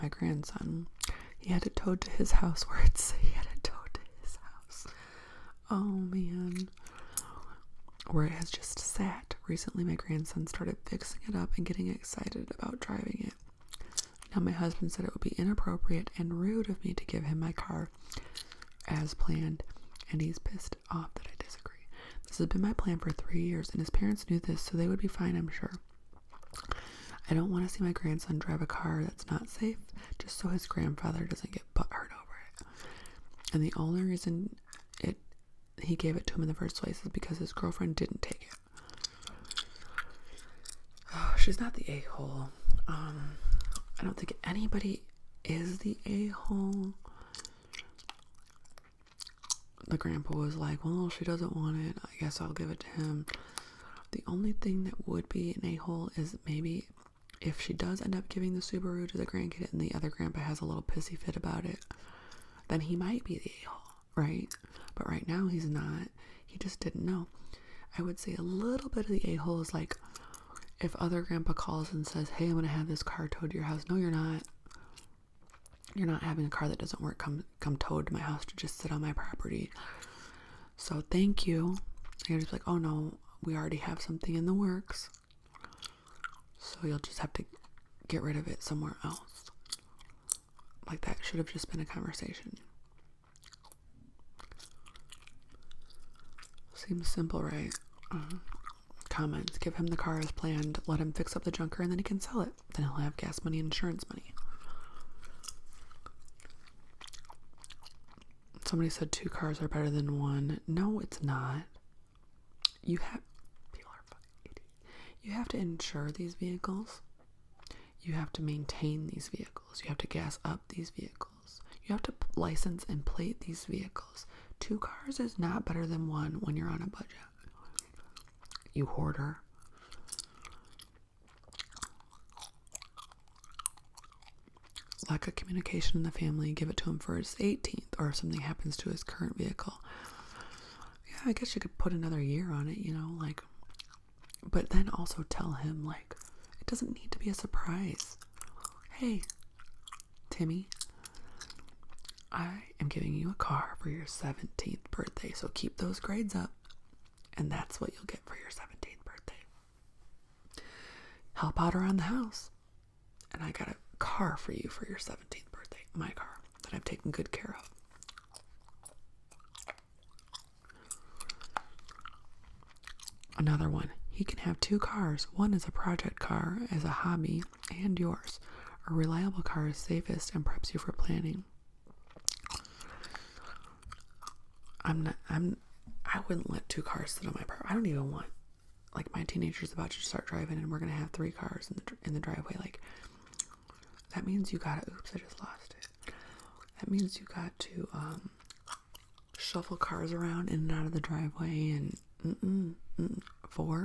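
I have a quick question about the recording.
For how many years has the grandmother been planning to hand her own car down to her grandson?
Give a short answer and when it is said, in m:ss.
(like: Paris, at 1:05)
3, at 0:23.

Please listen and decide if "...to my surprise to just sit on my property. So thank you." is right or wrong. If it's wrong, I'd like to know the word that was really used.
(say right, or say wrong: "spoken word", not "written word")
wrong: "house", not "surprise".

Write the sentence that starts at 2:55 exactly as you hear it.
One is a project car as a hobby and yours.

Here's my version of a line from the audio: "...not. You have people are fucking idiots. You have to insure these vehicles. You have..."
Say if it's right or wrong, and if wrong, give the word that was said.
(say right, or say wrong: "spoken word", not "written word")
right.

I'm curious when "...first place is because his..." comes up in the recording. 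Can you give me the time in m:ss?
0:36.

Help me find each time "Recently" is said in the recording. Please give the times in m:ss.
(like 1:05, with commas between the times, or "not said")
0:09.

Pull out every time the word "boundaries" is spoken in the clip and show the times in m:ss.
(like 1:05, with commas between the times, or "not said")
not said.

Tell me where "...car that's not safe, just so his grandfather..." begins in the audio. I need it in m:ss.
0:28.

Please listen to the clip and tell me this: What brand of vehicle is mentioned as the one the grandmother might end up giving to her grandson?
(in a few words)
Subaru.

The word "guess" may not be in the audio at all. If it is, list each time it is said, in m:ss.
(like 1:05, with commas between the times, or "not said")
0:52, 2:21.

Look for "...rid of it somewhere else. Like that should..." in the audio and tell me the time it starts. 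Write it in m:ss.
1:28.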